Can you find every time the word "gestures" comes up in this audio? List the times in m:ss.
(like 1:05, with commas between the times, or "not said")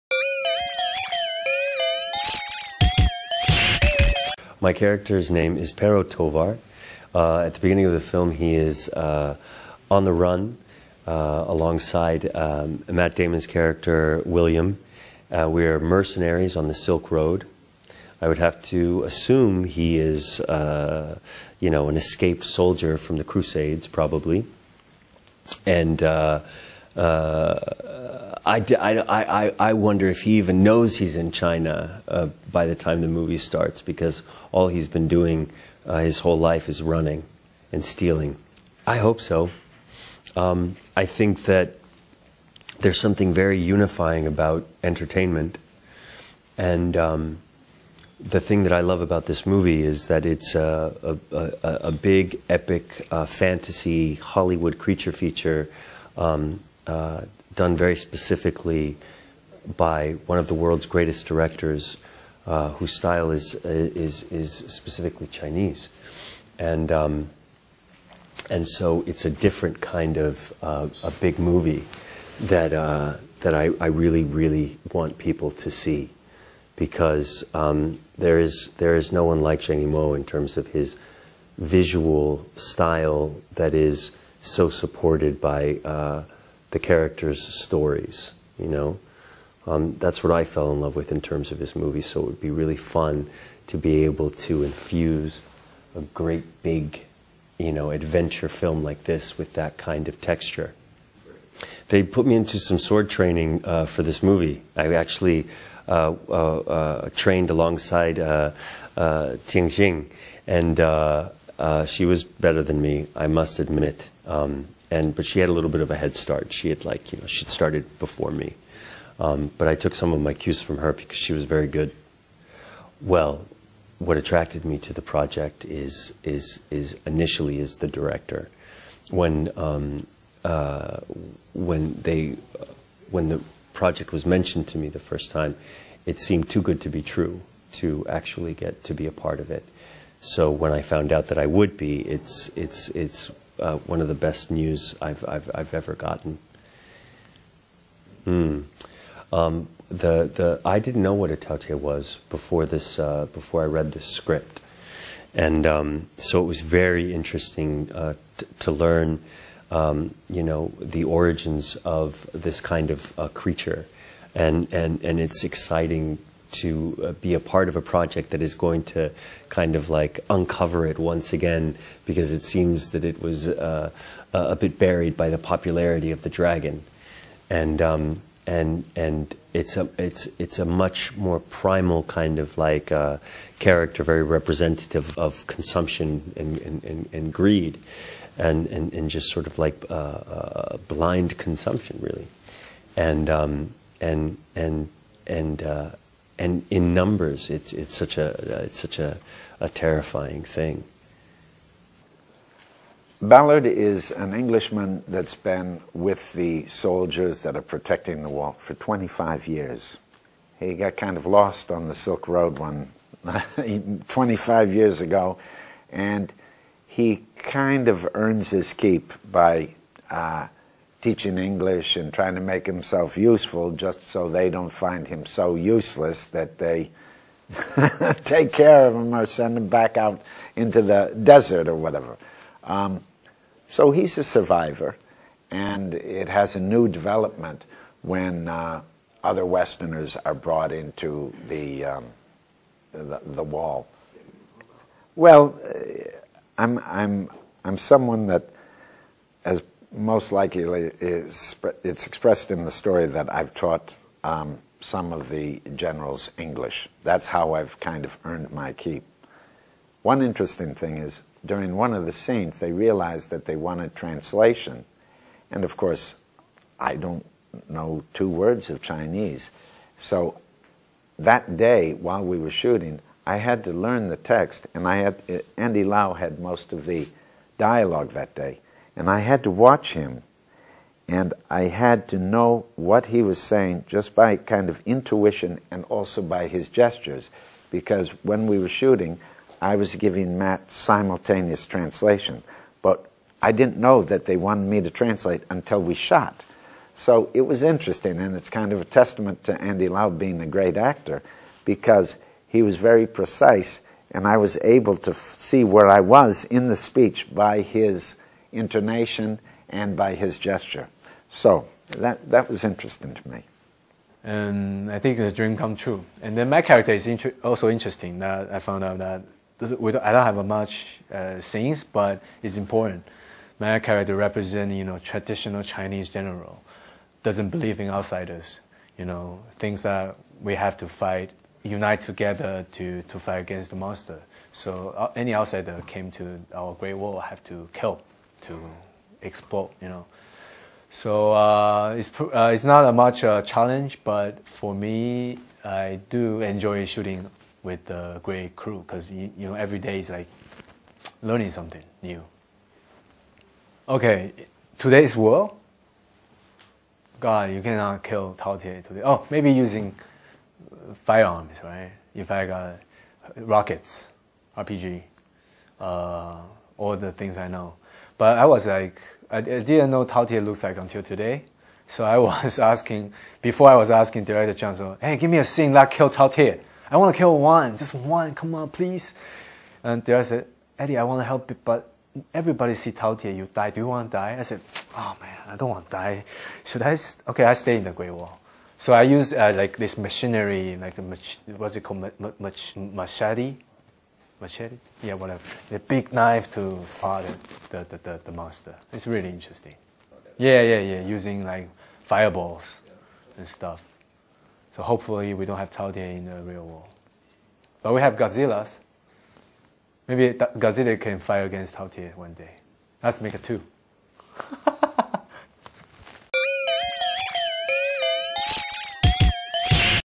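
4:46, 5:10.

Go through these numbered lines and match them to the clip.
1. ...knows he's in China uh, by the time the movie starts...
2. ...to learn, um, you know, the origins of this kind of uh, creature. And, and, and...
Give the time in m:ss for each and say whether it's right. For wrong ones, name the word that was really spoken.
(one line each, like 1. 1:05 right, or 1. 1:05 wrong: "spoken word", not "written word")
1. 0:30 right
2. 2:38 right.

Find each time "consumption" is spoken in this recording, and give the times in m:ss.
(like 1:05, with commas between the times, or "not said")
3:05, 3:11.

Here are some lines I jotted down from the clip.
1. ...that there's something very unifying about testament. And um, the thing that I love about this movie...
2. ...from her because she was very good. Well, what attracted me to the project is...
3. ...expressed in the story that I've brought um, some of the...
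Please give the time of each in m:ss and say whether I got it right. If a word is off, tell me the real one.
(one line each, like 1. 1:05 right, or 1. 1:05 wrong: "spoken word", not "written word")
1. 0:41 wrong: "entertainment", not "testament"
2. 2:00 right
3. 4:12 wrong: "taught", not "brought".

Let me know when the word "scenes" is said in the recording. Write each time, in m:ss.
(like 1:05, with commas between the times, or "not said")
4:22, 5:21, 6:15.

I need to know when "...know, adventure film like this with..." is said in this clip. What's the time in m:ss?
1:37.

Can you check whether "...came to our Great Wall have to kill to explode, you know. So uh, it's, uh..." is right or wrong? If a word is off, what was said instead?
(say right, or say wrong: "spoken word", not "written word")
right.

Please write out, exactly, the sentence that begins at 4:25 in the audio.
And of course, I don't know two words of Chinese.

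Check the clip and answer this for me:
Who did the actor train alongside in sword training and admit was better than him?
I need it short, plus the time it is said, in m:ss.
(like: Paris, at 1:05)
Ting, at 1:49.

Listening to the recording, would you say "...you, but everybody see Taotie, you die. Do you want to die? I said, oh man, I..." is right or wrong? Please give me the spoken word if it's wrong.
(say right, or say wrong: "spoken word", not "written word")
right.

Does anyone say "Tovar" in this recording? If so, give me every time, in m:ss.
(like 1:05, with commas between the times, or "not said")
0:06.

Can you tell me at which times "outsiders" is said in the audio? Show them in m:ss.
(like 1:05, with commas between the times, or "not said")
5:27, 5:35.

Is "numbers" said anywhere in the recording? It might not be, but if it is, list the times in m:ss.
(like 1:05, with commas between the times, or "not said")
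3:16.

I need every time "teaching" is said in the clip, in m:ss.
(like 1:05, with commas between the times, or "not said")
3:41.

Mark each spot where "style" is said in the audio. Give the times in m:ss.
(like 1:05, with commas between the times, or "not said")
1:02, 1:22.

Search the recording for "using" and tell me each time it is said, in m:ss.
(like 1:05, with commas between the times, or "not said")
5:59, 6:41.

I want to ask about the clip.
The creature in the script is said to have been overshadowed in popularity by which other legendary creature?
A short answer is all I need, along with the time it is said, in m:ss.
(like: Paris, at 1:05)
the dragon, at 2:56.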